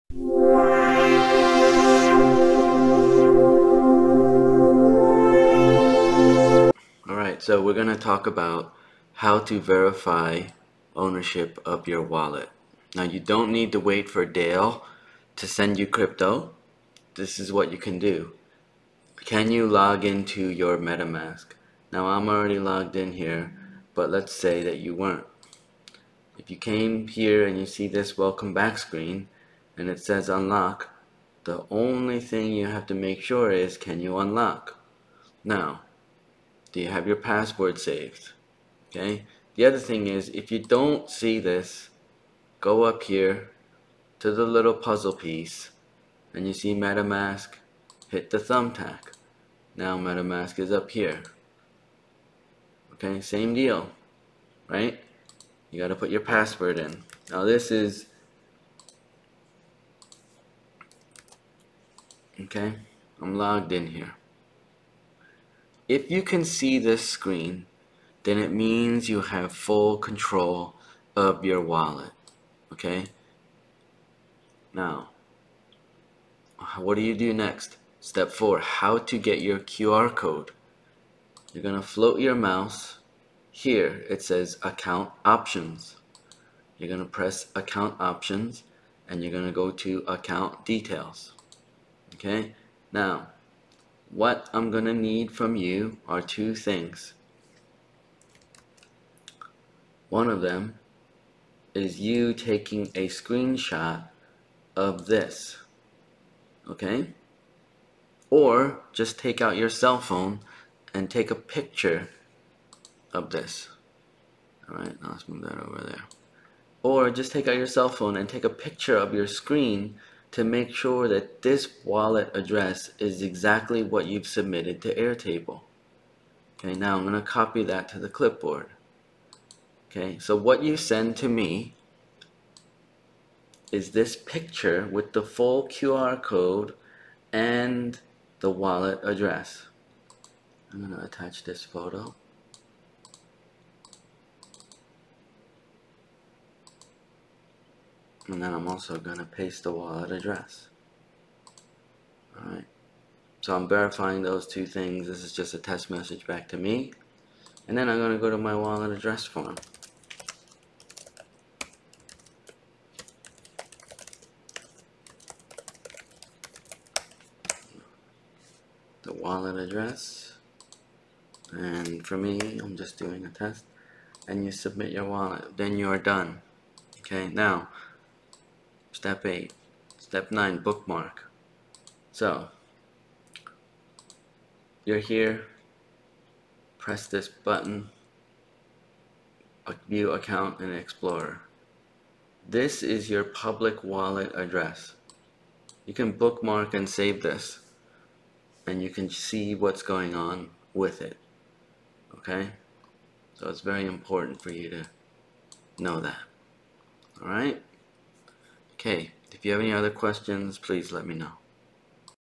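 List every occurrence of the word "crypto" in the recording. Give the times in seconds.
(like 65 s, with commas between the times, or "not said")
15 s.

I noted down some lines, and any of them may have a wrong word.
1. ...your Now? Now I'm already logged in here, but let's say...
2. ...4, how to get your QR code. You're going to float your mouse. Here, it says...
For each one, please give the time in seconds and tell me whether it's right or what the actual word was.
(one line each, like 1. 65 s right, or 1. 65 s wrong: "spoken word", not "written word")
1. 20 s wrong: "MetaMask", not "Now"
2. 78 s right.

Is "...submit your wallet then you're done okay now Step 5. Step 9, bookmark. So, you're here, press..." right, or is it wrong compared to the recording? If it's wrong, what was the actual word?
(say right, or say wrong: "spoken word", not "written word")
wrong: "8", not "5".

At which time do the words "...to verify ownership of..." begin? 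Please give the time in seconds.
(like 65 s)
9 s.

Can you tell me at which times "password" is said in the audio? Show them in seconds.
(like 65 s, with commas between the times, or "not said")
37 s, 56 s.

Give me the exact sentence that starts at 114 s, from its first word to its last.
Alright, Now let's move that over there.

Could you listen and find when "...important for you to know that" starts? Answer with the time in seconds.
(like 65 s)
203 s.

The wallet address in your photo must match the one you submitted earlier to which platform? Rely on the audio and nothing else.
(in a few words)
Airtable.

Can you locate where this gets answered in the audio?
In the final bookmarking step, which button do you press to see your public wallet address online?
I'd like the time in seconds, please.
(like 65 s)
189 s.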